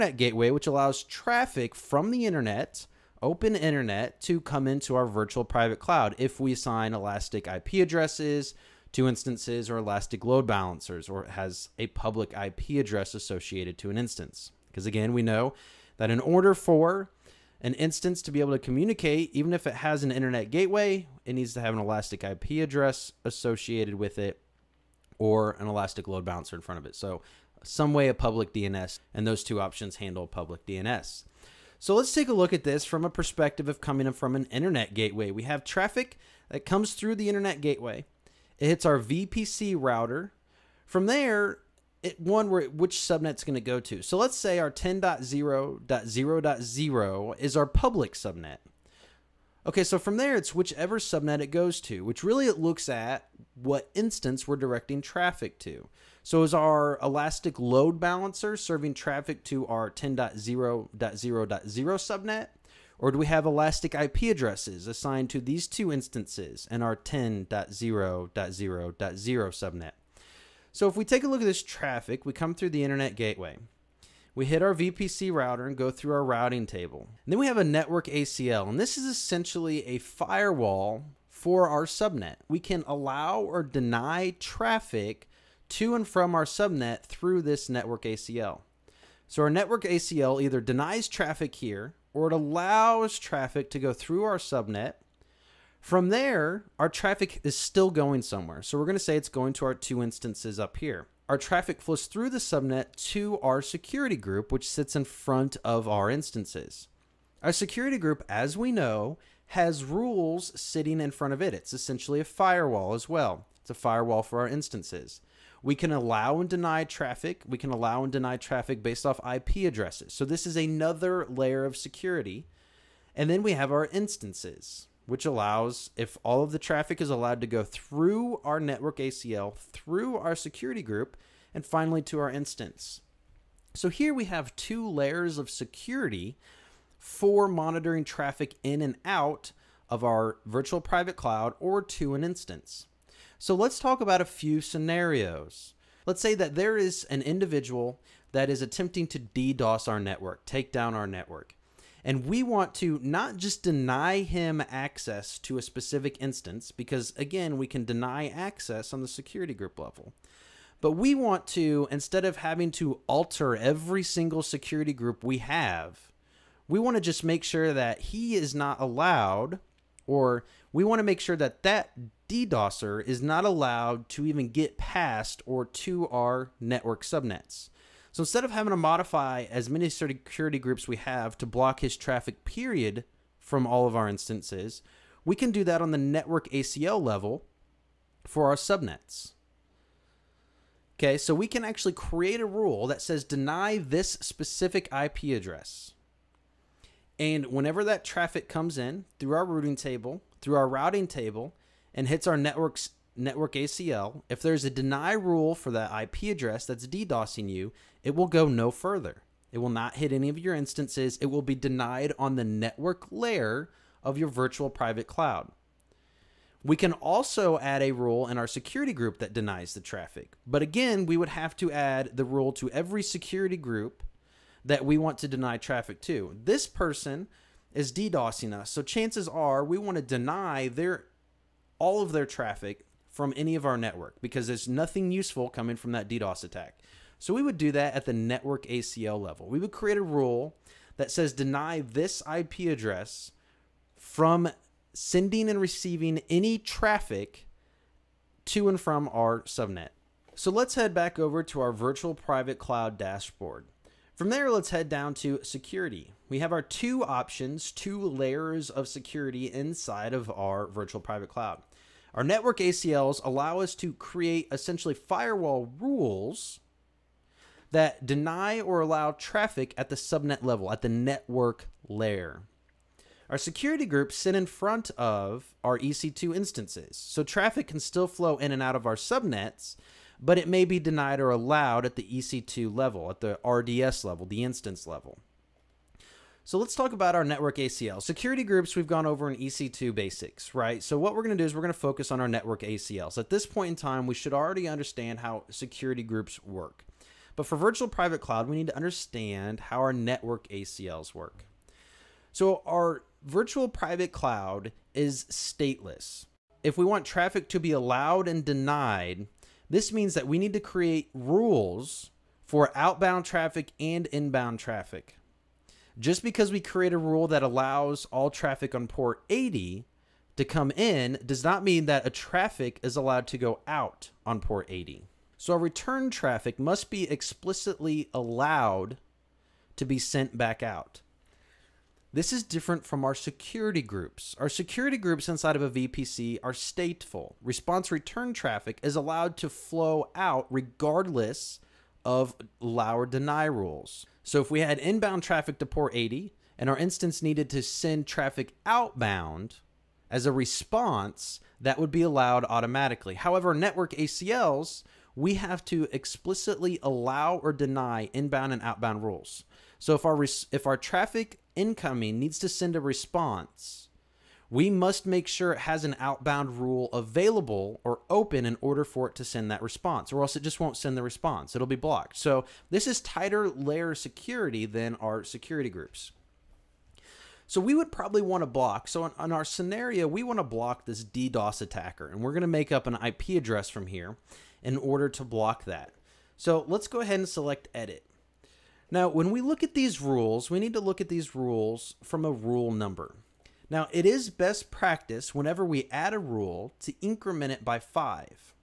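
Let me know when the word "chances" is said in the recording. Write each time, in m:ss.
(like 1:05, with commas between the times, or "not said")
3:48.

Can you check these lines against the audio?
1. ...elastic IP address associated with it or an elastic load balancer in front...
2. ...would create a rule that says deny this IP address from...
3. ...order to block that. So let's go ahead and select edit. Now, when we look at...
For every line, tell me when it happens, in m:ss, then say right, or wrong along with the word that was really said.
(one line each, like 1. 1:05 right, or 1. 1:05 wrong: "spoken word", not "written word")
1. 0:21 right
2. 3:59 right
3. 6:24 right.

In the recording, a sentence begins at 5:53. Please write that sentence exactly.
However, network ACLs, we have to explicitly allow or deny inbound and outbound rules.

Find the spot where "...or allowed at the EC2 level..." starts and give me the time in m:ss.
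4:41.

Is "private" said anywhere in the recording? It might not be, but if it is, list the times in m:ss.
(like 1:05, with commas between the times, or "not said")
0:05, 2:20, 3:34, 4:12, 4:21, 4:57, 5:03.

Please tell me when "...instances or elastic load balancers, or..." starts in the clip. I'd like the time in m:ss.
0:09.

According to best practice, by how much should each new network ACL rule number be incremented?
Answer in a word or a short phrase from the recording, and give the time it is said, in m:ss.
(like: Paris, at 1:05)
5, at 6:37.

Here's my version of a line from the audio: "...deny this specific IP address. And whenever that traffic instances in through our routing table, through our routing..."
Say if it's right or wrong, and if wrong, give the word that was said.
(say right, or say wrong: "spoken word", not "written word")
wrong: "comes", not "instances".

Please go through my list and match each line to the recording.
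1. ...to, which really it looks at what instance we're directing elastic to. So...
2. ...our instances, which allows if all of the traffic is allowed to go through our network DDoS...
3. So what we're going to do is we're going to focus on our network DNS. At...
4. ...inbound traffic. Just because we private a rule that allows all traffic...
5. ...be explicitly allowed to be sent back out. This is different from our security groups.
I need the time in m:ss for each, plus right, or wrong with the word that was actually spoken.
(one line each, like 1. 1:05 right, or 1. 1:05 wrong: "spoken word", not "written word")
1. 0:51 wrong: "traffic", not "elastic"
2. 2:03 wrong: "ACL", not "DDoS"
3. 4:50 wrong: "ACLs", not "DNS"
4. 5:14 wrong: "create", not "private"
5. 5:26 right.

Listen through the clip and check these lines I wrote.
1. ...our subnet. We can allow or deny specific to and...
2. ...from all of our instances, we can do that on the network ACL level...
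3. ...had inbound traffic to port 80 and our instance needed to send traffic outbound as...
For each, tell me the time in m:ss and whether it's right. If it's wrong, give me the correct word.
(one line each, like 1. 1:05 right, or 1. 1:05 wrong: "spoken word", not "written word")
1. 1:21 wrong: "traffic", not "specific"
2. 3:03 right
3. 5:44 right.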